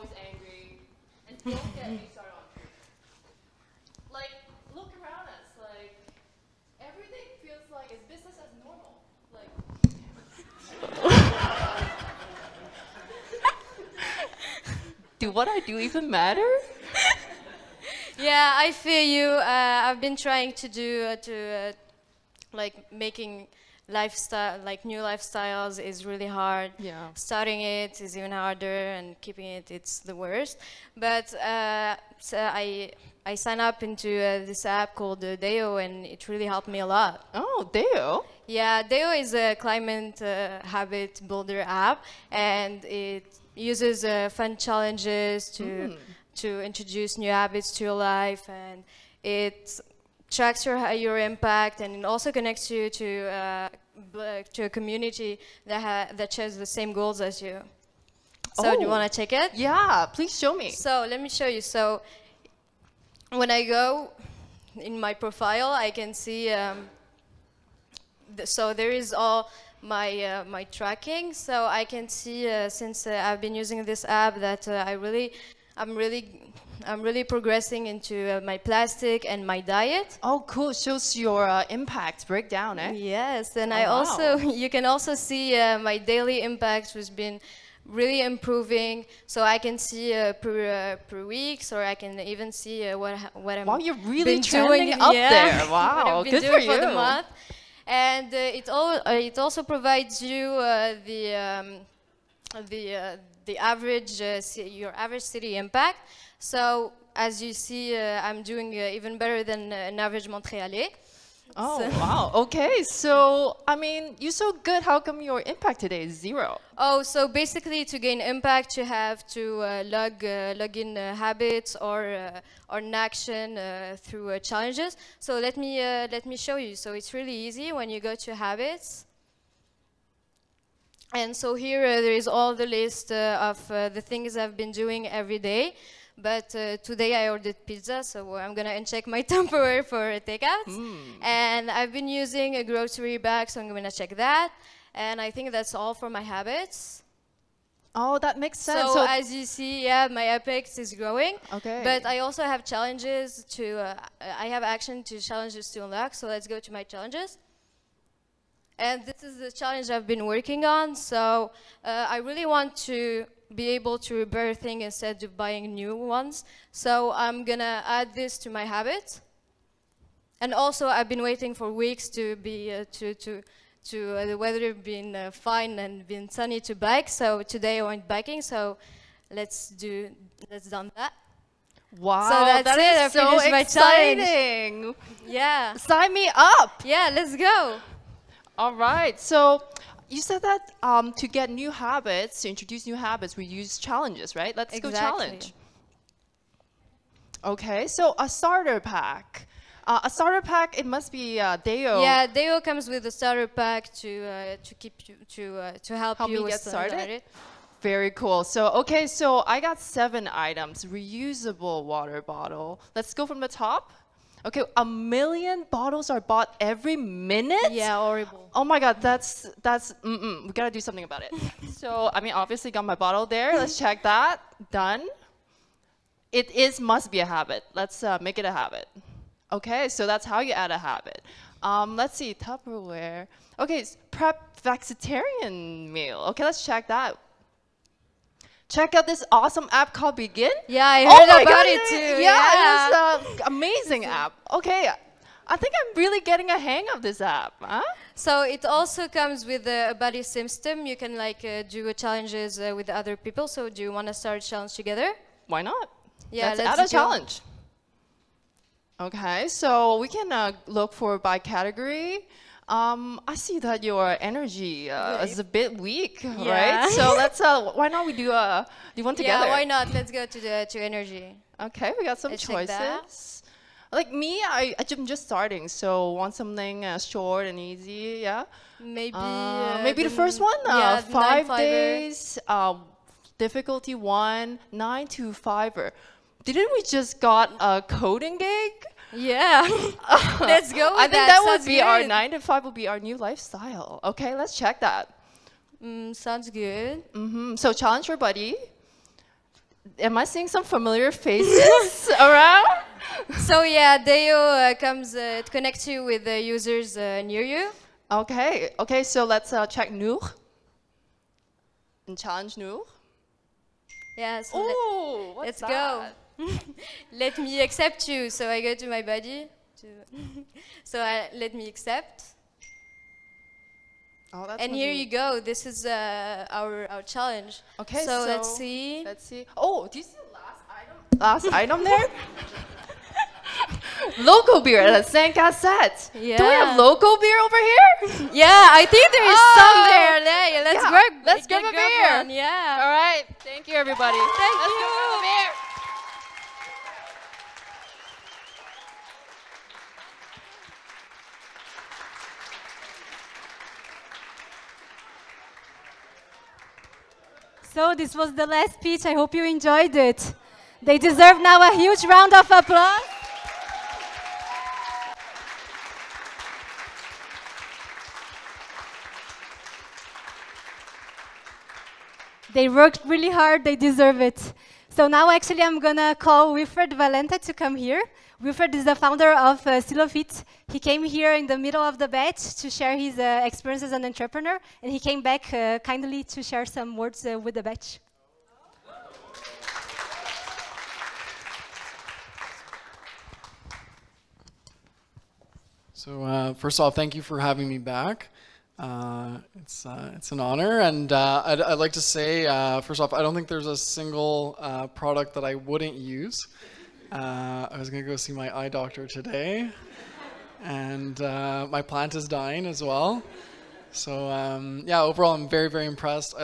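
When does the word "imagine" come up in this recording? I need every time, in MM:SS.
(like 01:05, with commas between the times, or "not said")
not said.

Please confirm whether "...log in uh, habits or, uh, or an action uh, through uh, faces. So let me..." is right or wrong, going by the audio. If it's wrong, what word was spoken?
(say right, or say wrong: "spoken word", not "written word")
wrong: "challenges", not "faces".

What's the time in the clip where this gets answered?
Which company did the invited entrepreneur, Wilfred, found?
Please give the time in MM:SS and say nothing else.
06:19.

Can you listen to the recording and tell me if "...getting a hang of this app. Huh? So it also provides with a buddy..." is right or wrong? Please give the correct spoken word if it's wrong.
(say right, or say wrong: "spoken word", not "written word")
wrong: "comes", not "provides".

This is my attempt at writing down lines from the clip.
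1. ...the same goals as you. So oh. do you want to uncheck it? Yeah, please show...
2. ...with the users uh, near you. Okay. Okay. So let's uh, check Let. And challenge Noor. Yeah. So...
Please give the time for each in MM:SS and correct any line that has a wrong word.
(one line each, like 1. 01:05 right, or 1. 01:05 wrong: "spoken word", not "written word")
1. 00:56 wrong: "check", not "uncheck"
2. 05:06 wrong: "Noor", not "Let".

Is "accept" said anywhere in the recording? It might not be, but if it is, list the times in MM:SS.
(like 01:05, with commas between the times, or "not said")
05:17, 05:21.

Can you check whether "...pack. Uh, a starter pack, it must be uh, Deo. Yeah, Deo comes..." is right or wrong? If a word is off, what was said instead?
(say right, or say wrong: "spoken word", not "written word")
right.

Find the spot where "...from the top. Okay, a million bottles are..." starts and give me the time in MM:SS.
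03:33.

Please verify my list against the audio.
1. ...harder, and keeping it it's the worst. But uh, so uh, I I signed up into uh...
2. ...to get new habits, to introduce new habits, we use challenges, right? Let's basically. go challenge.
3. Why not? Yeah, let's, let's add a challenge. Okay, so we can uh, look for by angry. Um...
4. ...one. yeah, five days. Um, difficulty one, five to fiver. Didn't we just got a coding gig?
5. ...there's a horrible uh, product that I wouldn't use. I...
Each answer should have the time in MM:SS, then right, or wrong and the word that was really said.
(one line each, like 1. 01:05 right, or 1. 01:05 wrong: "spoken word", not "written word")
1. 00:28 right
2. 03:11 wrong: "exactly", not "basically"
3. 04:15 wrong: "category", not "angry"
4. 04:40 wrong: "nine", not "five"
5. 06:43 wrong: "single", not "horrible".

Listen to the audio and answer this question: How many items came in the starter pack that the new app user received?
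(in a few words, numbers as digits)
7.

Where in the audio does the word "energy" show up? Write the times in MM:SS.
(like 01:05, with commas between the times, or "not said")
04:24, 04:30.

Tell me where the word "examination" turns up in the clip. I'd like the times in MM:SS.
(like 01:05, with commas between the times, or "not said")
not said.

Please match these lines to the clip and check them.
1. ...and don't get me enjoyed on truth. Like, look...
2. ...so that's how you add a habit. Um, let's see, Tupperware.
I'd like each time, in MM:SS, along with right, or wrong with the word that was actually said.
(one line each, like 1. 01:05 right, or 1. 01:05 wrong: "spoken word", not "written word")
1. 00:01 wrong: "started", not "enjoyed"
2. 03:49 right.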